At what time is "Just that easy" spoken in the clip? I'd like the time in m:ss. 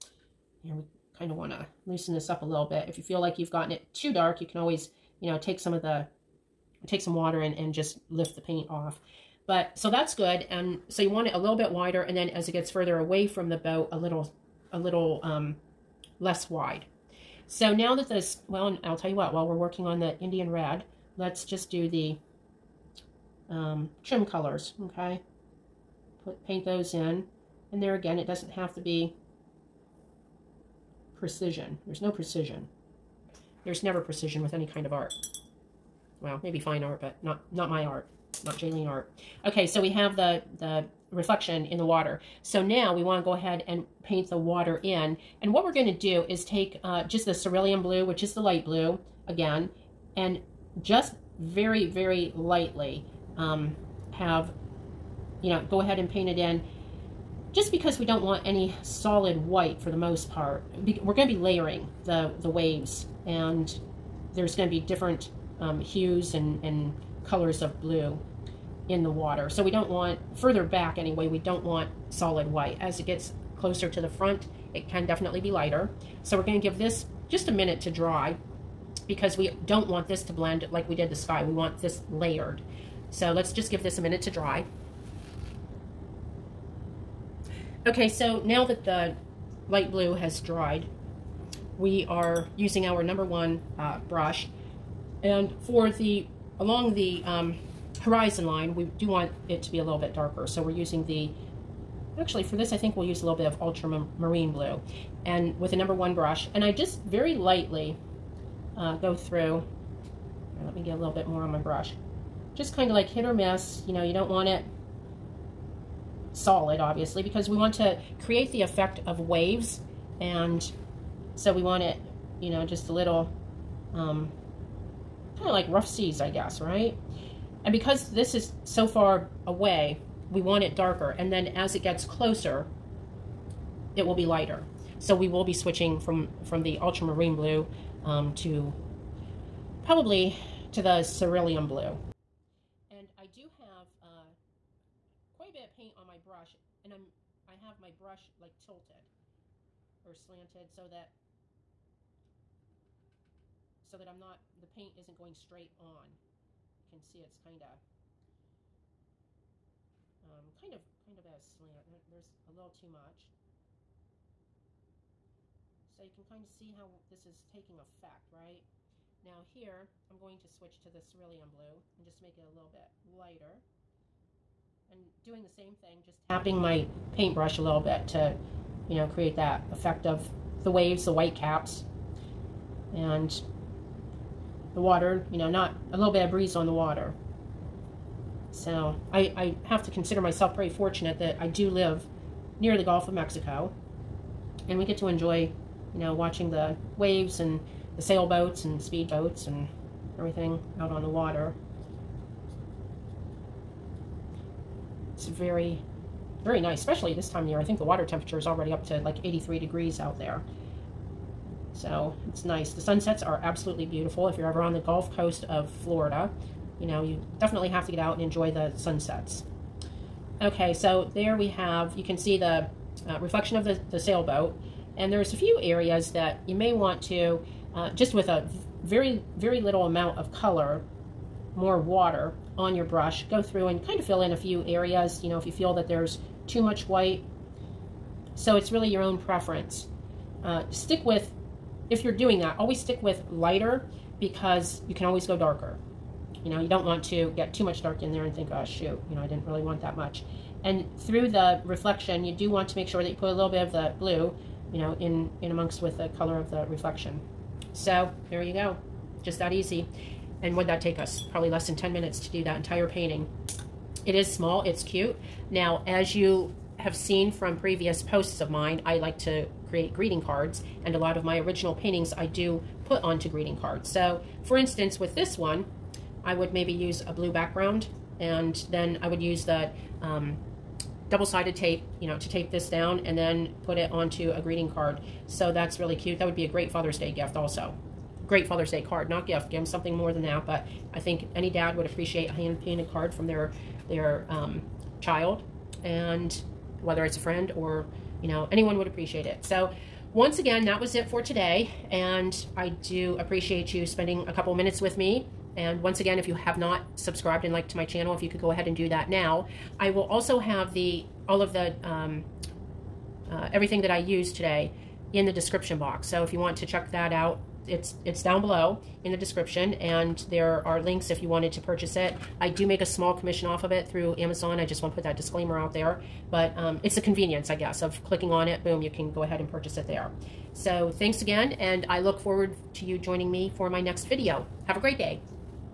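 4:19.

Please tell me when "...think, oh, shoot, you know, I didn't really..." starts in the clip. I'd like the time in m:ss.
4:08.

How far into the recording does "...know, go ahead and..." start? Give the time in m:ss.
0:55.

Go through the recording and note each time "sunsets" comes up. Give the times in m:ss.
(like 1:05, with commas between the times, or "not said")
3:32, 3:38.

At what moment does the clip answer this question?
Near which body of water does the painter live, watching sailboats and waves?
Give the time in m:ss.
3:12.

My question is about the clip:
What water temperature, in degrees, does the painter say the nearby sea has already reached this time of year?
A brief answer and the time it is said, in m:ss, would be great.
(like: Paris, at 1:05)
83, at 3:29.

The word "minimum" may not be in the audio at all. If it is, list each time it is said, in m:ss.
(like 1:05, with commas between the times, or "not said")
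not said.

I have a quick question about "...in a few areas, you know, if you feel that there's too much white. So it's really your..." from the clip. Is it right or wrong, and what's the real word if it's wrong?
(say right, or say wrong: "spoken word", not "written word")
right.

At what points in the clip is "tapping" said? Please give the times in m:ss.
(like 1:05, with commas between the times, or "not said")
2:56.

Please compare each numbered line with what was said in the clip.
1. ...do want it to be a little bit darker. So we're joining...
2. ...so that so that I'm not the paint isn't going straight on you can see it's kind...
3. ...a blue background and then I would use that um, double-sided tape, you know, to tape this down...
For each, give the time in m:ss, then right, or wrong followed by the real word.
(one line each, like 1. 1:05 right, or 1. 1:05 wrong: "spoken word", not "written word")
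1. 1:38 wrong: "using", not "joining"
2. 2:30 right
3. 4:37 right.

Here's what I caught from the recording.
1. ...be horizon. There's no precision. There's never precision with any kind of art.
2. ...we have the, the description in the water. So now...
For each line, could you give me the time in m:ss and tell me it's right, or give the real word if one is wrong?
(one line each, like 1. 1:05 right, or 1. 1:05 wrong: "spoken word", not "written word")
1. 0:28 wrong: "precision", not "horizon"
2. 0:39 wrong: "reflection", not "description".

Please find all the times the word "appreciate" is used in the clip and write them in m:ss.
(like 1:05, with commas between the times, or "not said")
4:51, 4:58, 5:03.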